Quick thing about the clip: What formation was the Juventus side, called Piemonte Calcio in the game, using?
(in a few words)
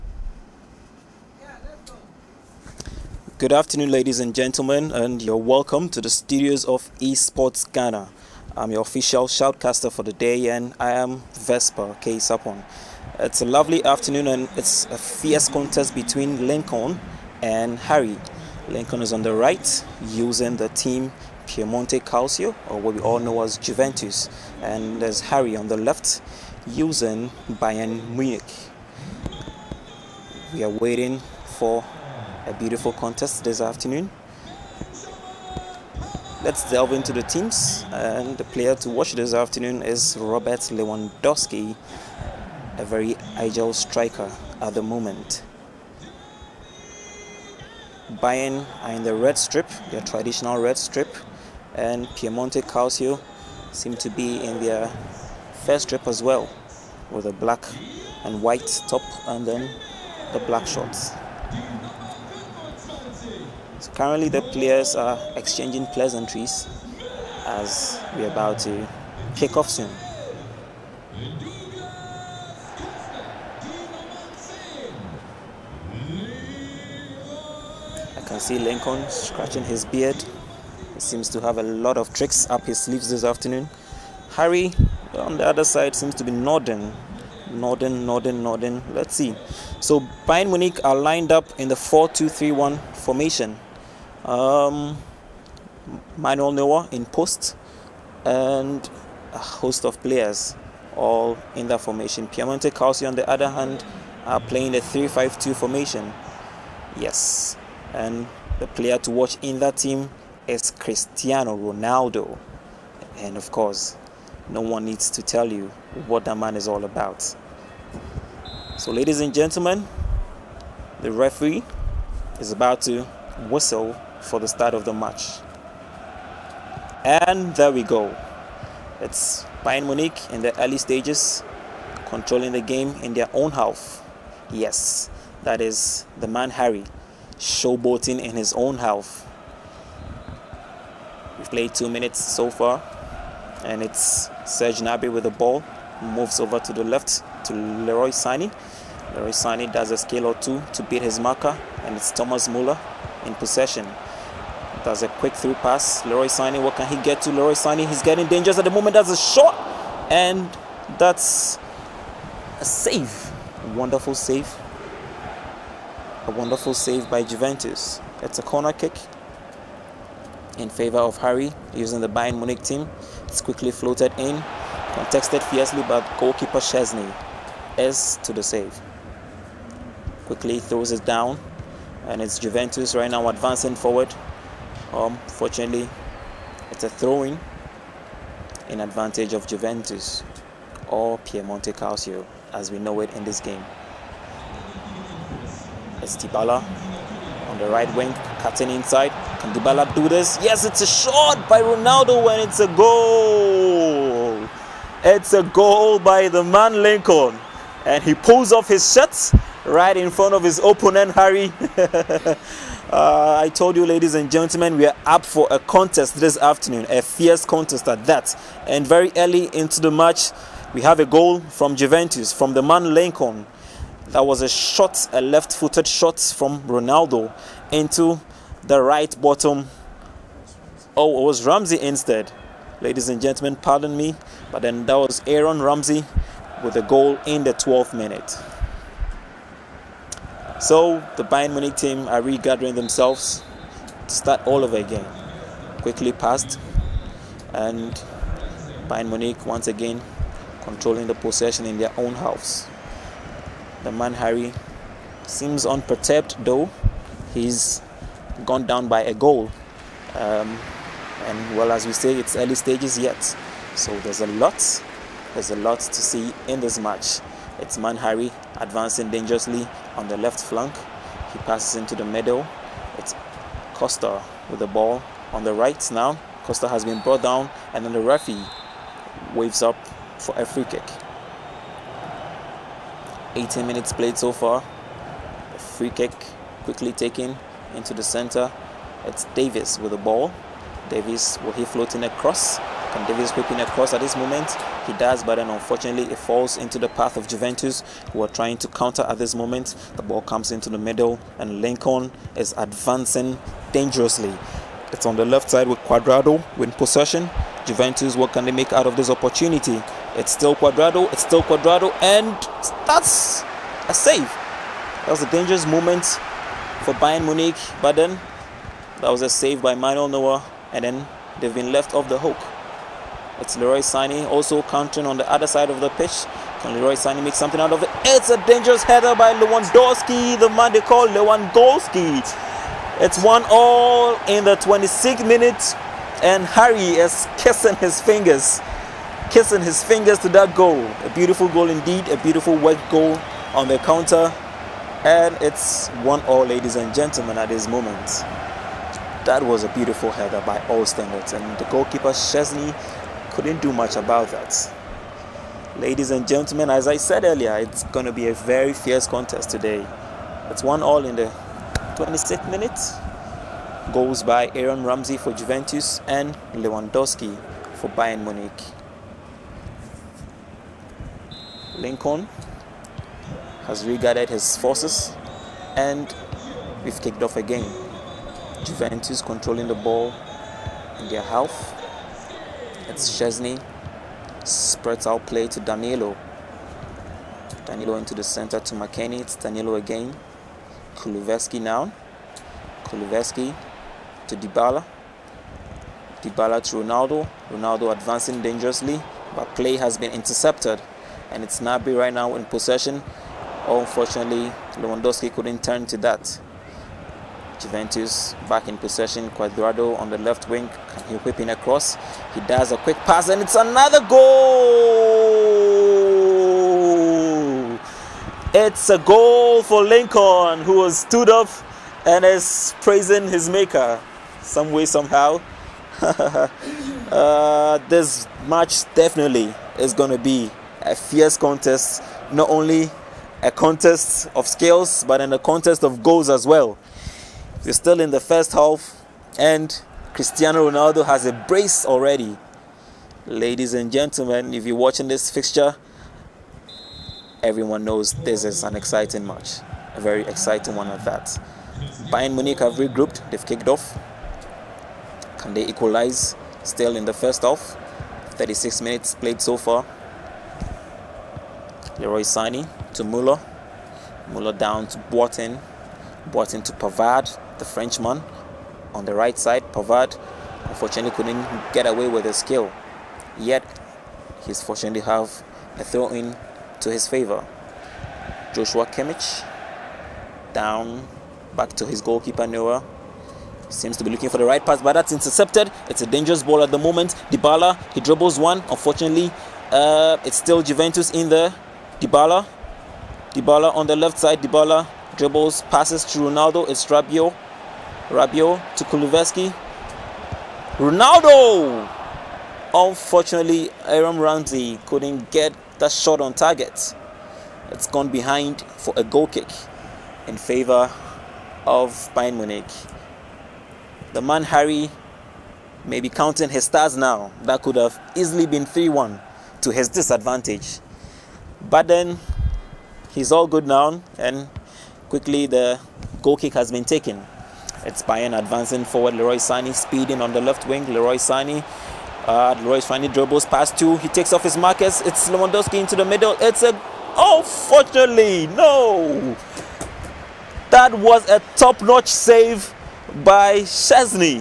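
3-5-2.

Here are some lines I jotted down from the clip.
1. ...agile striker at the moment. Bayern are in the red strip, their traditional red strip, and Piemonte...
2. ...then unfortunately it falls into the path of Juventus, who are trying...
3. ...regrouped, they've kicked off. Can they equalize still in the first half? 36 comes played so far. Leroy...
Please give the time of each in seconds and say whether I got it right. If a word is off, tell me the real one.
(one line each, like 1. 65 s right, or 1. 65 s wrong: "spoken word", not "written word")
1. 43 s right
2. 295 s right
3. 452 s wrong: "minutes", not "comes".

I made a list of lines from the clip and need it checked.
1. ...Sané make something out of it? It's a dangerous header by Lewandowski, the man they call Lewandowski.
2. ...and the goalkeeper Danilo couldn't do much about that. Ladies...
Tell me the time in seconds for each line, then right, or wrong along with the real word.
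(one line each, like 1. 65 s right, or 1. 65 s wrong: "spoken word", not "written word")
1. 326 s right
2. 351 s wrong: "Szczęsny", not "Danilo".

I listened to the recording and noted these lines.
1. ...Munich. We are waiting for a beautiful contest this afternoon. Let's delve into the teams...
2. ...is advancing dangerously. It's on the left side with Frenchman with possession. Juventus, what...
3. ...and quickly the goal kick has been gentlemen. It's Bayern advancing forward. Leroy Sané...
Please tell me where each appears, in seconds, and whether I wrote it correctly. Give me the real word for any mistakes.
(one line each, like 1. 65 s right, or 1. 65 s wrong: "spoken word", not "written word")
1. 28 s right
2. 302 s wrong: "Cuadrado", not "Frenchman"
3. 524 s wrong: "taken", not "gentlemen".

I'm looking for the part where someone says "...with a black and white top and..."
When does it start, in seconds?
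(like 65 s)
57 s.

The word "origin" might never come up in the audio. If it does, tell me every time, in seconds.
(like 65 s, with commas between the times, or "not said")
not said.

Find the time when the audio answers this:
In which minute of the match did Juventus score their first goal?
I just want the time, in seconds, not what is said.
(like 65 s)
237 s.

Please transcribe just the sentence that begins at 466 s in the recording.
Boateng to Pavard the Frenchman on the right side, Pavard, unfortunately couldn't get away with his skill.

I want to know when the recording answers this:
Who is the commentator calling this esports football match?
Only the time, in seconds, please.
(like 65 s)
11 s.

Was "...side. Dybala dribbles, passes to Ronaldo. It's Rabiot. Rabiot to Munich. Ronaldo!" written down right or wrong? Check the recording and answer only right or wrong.
wrong.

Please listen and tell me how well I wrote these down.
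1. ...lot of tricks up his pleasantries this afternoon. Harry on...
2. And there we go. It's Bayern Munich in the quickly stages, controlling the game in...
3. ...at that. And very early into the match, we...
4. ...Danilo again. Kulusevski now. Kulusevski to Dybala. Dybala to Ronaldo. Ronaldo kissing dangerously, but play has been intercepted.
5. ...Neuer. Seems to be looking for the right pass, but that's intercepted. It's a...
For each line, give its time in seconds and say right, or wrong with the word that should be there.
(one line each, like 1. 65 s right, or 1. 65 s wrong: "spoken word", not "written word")
1. 81 s wrong: "sleeves", not "pleasantries"
2. 127 s wrong: "early", not "quickly"
3. 217 s right
4. 389 s wrong: "advancing", not "kissing"
5. 482 s right.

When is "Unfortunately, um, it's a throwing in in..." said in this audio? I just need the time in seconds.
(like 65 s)
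184 s.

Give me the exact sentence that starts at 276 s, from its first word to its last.
Costa has been brought down, and then the referee waves up for a free kick.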